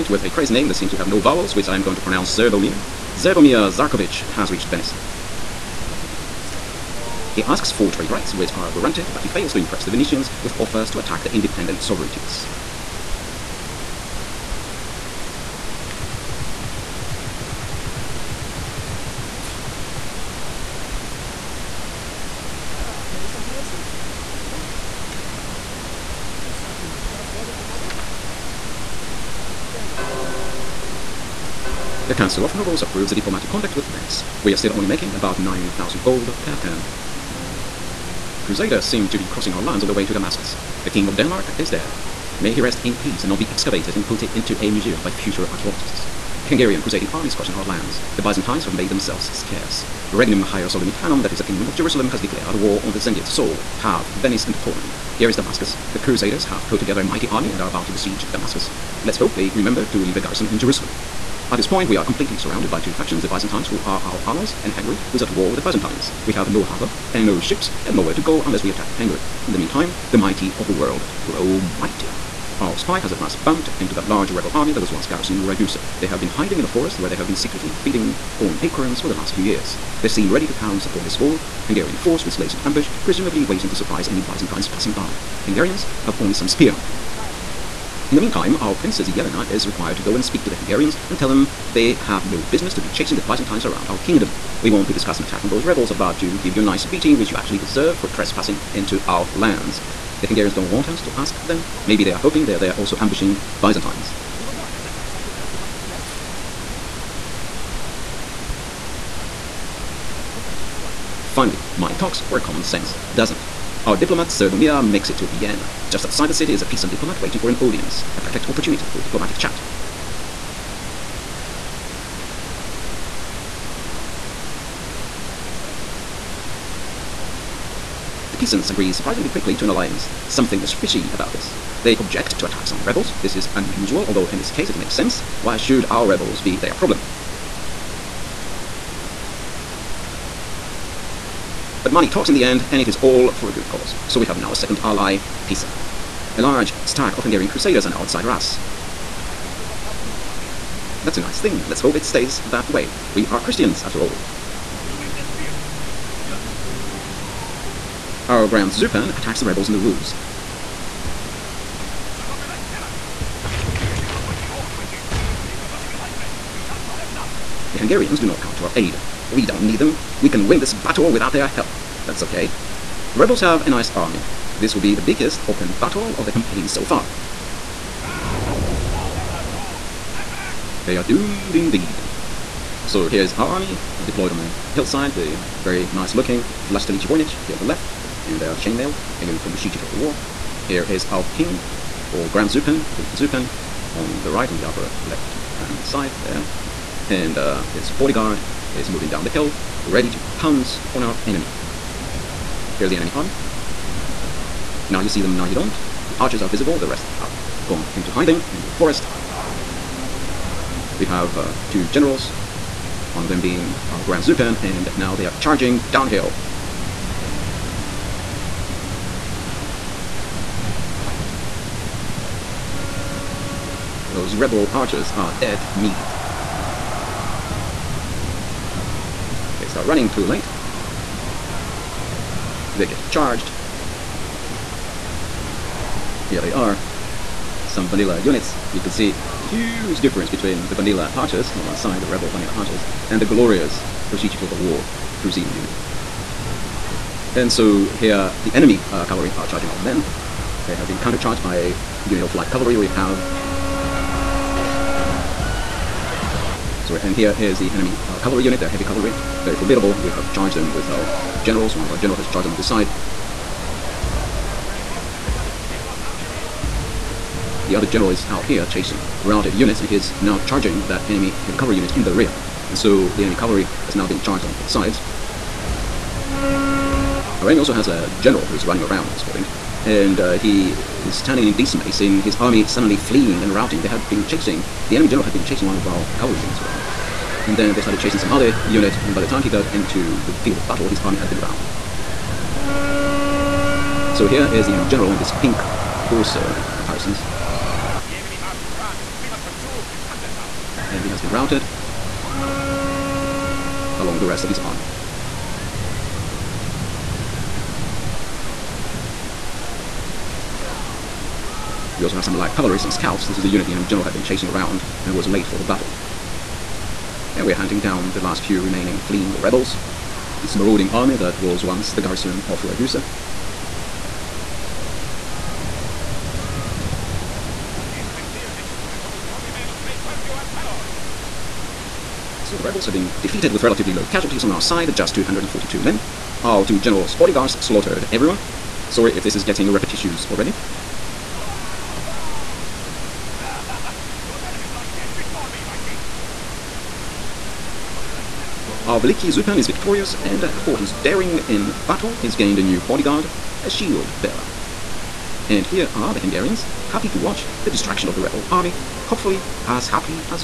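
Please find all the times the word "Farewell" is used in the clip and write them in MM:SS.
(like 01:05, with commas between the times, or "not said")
00:29.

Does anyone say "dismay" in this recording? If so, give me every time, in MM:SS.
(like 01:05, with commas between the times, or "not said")
04:41.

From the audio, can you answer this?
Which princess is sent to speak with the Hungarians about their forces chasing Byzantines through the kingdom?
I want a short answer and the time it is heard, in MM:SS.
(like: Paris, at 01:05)
Yelena, at 01:28.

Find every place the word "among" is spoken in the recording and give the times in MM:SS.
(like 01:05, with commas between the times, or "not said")
02:30.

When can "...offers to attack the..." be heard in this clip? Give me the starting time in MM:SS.
00:10.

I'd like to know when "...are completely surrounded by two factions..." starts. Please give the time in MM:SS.
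01:01.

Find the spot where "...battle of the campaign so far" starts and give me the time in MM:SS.
02:55.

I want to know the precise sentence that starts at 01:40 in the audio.
The Hungarians don't want us to ask them.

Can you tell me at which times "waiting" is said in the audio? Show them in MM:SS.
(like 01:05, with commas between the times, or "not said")
01:23, 01:57.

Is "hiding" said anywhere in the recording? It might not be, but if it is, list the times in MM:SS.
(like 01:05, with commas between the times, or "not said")
01:16, 03:28.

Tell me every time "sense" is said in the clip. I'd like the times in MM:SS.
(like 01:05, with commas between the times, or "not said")
01:52, 02:14.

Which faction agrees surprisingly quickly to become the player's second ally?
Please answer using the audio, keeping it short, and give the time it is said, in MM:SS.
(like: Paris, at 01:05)
Pisa, at 02:25.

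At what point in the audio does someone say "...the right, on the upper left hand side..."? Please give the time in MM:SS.
03:14.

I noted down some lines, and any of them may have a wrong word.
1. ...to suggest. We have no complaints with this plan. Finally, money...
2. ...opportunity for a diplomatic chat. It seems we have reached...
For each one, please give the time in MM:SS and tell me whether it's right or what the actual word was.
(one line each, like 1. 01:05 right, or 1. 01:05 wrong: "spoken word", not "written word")
1. 01:45 right
2. 01:58 right.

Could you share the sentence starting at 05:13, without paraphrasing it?
This is the unit the enemy general had been chasing around and was late for the battle.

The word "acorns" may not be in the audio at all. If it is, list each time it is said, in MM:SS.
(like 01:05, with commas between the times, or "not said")
01:18.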